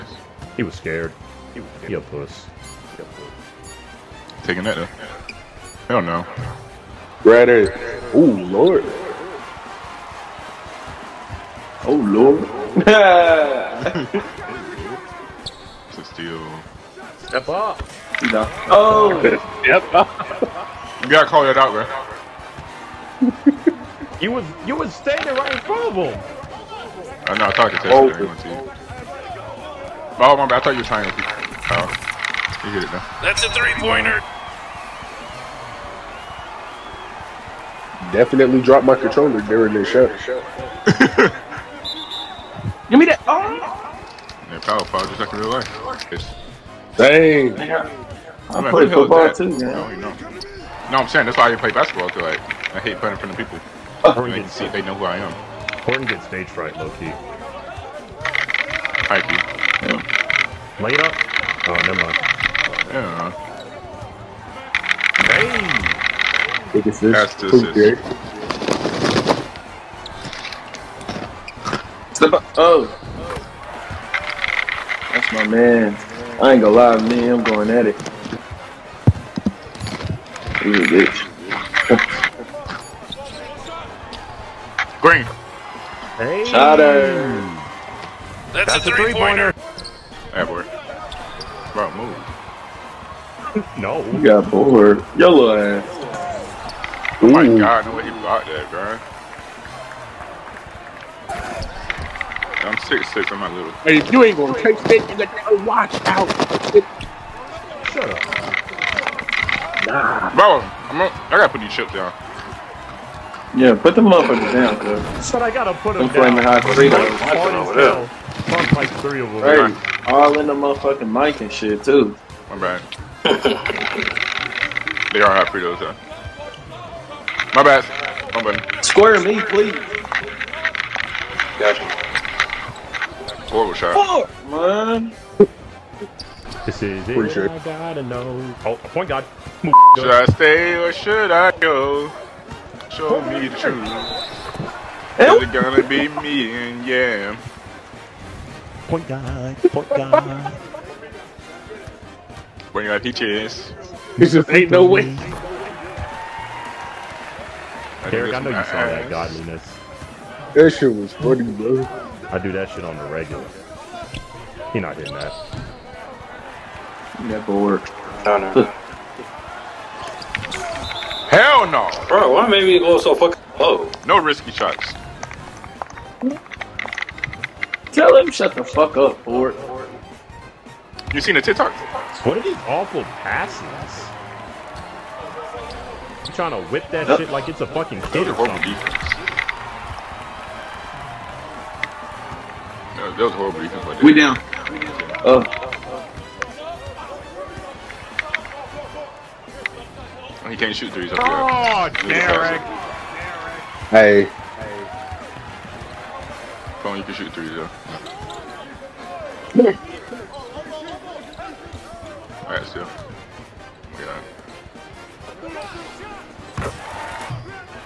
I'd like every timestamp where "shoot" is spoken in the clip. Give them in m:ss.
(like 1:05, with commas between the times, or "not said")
3:20, 3:27.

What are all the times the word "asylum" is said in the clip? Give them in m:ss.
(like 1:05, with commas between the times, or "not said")
not said.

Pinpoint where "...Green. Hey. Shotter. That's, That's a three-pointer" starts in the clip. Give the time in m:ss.
1:24.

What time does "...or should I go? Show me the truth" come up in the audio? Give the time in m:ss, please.
2:20.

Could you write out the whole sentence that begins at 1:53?
Yeah, put them the and down, dude.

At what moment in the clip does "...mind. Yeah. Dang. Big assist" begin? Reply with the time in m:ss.
1:01.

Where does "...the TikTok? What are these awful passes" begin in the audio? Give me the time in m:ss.
3:01.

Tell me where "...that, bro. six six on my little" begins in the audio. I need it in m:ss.
1:38.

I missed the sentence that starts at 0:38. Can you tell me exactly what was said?
Definitely dropped my controller during this shot.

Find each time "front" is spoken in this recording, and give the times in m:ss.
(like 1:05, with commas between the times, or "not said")
0:25, 0:53.